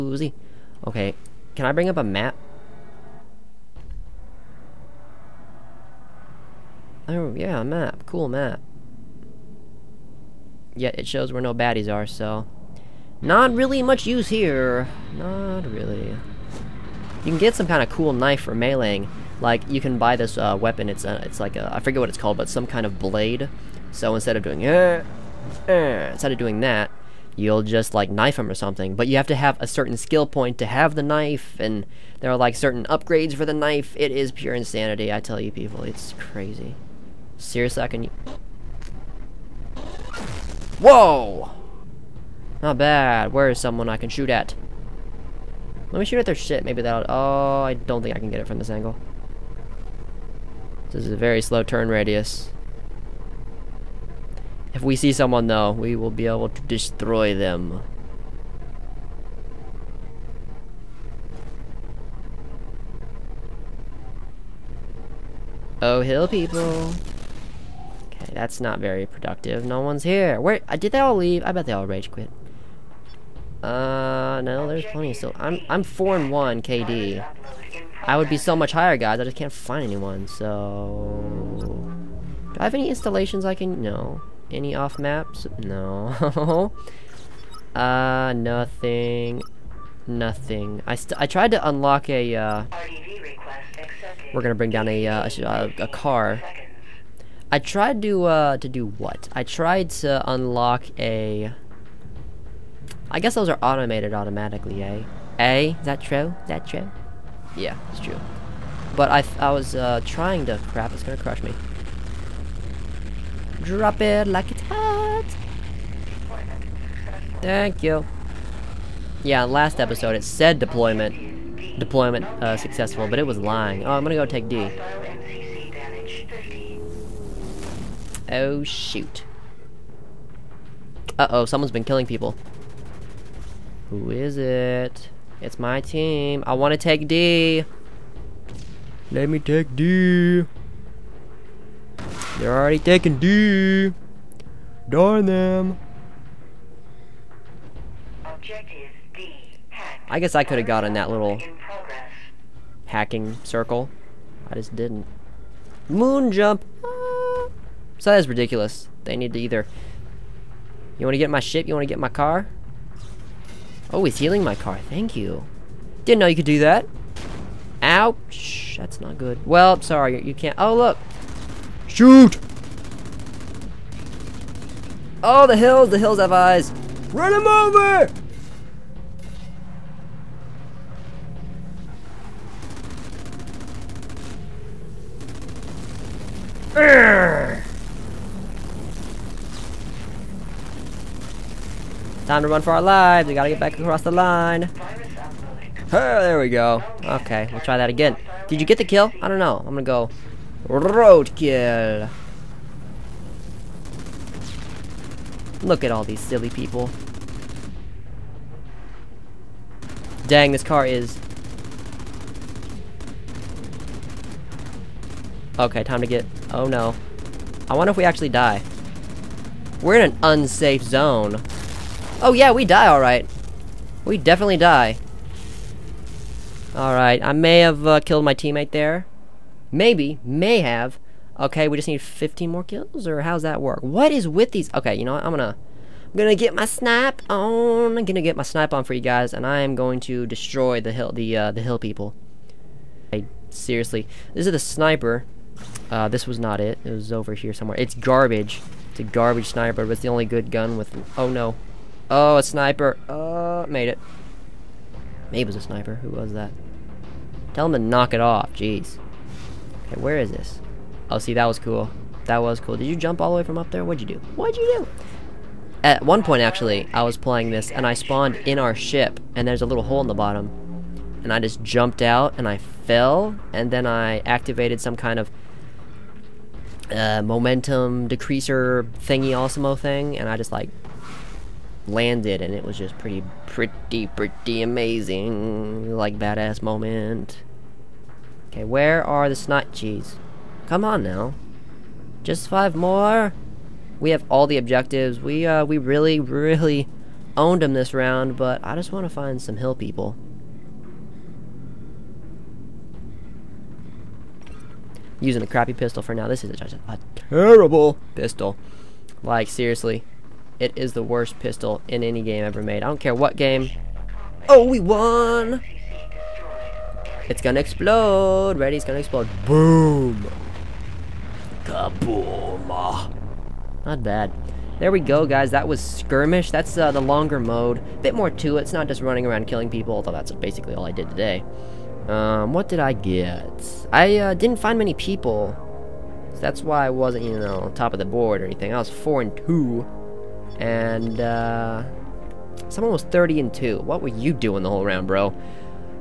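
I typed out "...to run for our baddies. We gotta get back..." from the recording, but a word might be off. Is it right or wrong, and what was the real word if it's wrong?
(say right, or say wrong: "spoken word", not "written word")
wrong: "lives", not "baddies".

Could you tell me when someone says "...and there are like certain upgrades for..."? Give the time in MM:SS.
00:31.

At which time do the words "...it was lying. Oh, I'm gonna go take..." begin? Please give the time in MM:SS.
02:03.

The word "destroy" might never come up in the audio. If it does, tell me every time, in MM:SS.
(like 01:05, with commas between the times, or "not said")
00:56, 04:00.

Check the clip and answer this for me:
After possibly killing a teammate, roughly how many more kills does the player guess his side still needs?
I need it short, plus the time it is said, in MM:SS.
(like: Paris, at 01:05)
15, at 03:51.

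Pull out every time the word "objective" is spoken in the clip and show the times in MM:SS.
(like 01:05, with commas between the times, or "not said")
02:28, 04:54.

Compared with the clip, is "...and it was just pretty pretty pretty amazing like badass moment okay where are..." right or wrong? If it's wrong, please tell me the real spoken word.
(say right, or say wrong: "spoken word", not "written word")
right.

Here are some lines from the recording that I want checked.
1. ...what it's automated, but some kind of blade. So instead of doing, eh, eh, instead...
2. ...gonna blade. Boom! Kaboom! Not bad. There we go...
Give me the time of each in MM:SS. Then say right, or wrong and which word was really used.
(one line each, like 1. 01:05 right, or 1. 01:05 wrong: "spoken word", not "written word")
1. 00:21 wrong: "called", not "automated"
2. 05:18 wrong: "explode", not "blade".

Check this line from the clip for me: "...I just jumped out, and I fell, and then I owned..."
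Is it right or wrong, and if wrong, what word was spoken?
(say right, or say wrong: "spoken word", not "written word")
wrong: "activated", not "owned".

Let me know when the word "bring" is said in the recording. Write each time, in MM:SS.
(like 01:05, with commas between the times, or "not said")
00:01, 01:34.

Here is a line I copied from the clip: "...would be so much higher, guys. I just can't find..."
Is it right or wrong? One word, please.
right.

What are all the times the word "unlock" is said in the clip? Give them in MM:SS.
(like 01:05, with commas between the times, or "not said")
01:31, 01:40.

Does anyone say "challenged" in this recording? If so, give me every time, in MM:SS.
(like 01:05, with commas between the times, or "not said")
not said.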